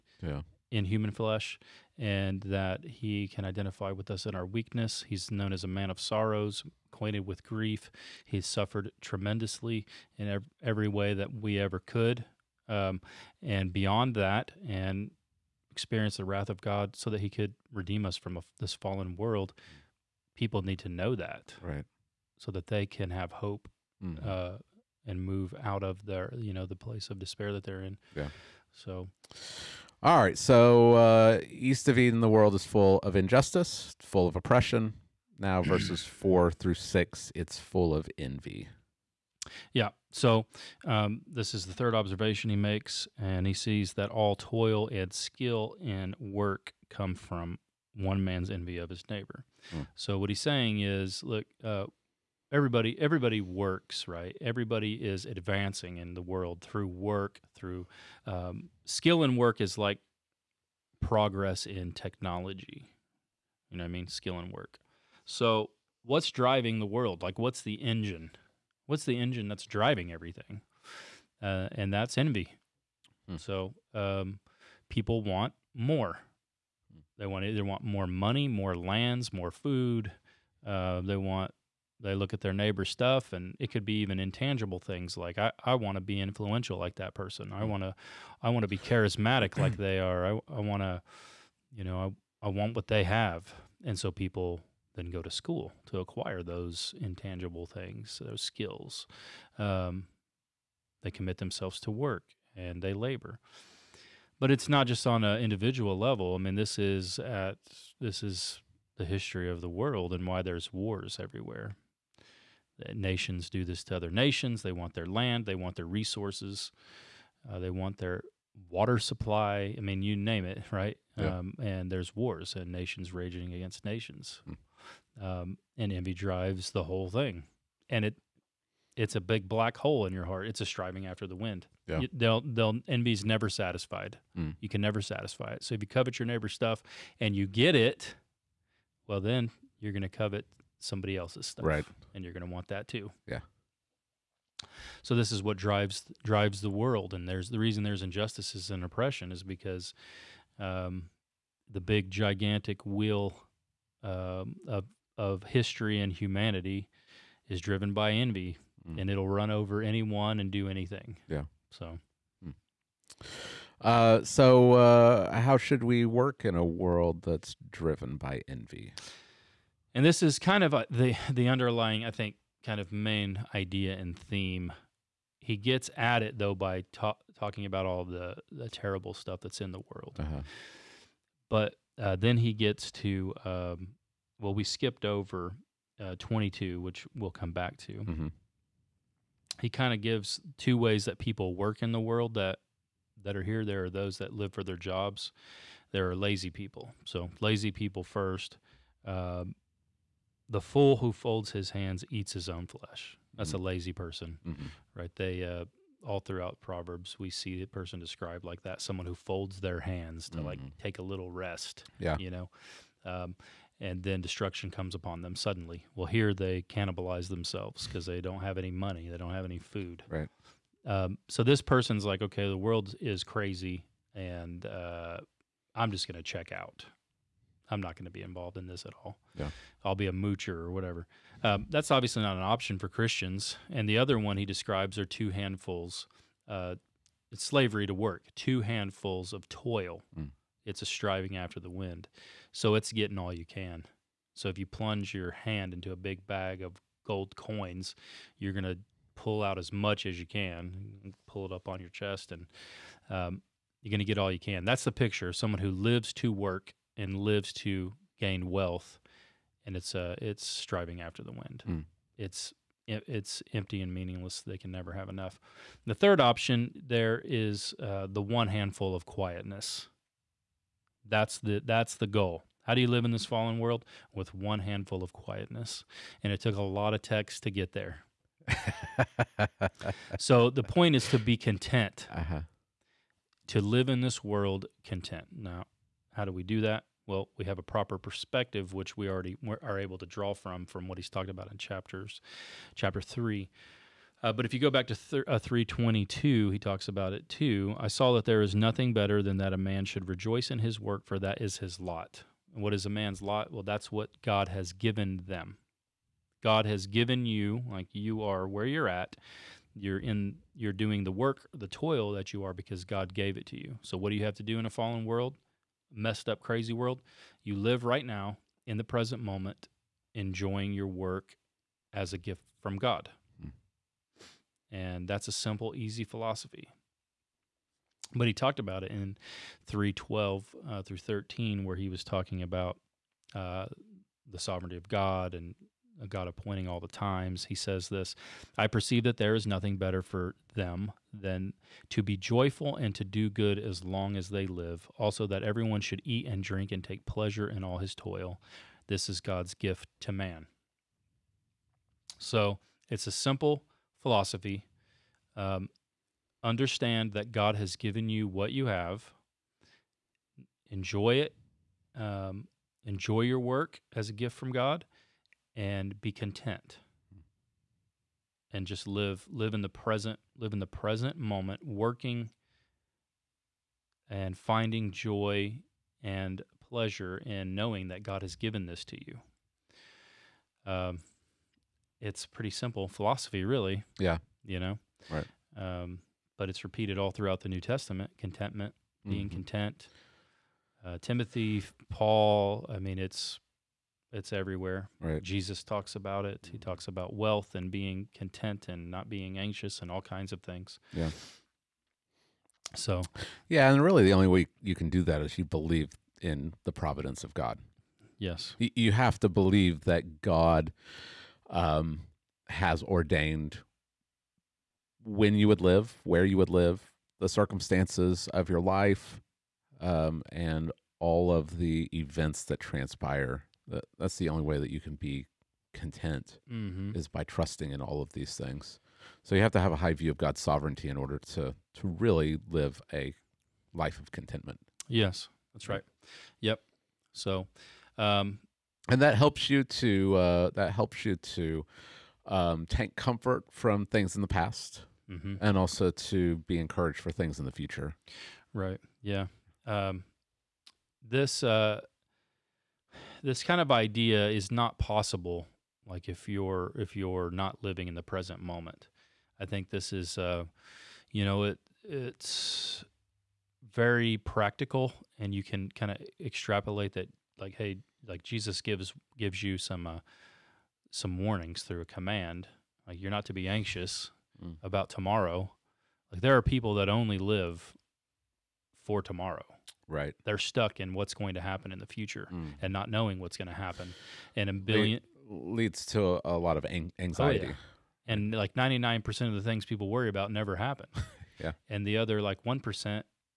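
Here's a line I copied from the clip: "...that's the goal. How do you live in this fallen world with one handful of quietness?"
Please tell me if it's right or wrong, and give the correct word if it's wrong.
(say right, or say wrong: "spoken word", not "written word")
right.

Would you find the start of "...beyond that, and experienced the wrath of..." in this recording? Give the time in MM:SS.
00:13.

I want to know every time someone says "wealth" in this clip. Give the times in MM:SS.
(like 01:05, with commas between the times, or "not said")
04:18, 06:37.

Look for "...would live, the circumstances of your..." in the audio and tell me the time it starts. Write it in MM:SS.
06:56.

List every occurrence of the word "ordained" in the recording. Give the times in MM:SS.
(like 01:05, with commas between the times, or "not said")
06:52.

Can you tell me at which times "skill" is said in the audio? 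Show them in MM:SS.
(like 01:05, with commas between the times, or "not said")
00:45, 00:58, 01:04, 01:38.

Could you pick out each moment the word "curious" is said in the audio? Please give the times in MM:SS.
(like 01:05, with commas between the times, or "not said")
not said.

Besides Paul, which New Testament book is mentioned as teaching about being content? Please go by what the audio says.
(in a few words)
Timothy.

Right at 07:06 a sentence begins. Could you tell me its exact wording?
is by trusting in all of these things.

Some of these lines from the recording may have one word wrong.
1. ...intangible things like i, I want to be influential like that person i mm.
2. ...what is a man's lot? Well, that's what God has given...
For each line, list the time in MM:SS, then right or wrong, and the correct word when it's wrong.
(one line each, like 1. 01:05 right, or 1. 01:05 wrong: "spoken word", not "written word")
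1. 01:24 right
2. 05:02 right.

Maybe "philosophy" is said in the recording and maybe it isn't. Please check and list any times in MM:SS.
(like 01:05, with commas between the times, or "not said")
05:26, 05:54, 06:22.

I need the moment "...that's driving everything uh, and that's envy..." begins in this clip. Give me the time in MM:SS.
01:09.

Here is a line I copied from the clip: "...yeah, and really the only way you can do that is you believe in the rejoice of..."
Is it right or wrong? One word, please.
wrong.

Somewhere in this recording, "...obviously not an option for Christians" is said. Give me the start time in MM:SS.
03:51.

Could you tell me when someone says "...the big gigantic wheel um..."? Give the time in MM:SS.
02:31.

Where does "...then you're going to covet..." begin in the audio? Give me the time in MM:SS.
02:19.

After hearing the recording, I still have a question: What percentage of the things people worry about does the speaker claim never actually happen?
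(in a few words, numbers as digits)
99%.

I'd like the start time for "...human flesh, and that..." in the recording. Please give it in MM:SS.
00:00.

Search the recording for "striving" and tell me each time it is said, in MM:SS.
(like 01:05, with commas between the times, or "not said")
02:10, 04:00, 04:20.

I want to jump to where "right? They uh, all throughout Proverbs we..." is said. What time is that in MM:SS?
03:24.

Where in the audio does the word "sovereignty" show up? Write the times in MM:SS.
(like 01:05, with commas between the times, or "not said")
05:34, 07:10.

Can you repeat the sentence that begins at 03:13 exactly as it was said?
There are those that live for their jobs.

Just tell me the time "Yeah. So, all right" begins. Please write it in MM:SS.
00:28.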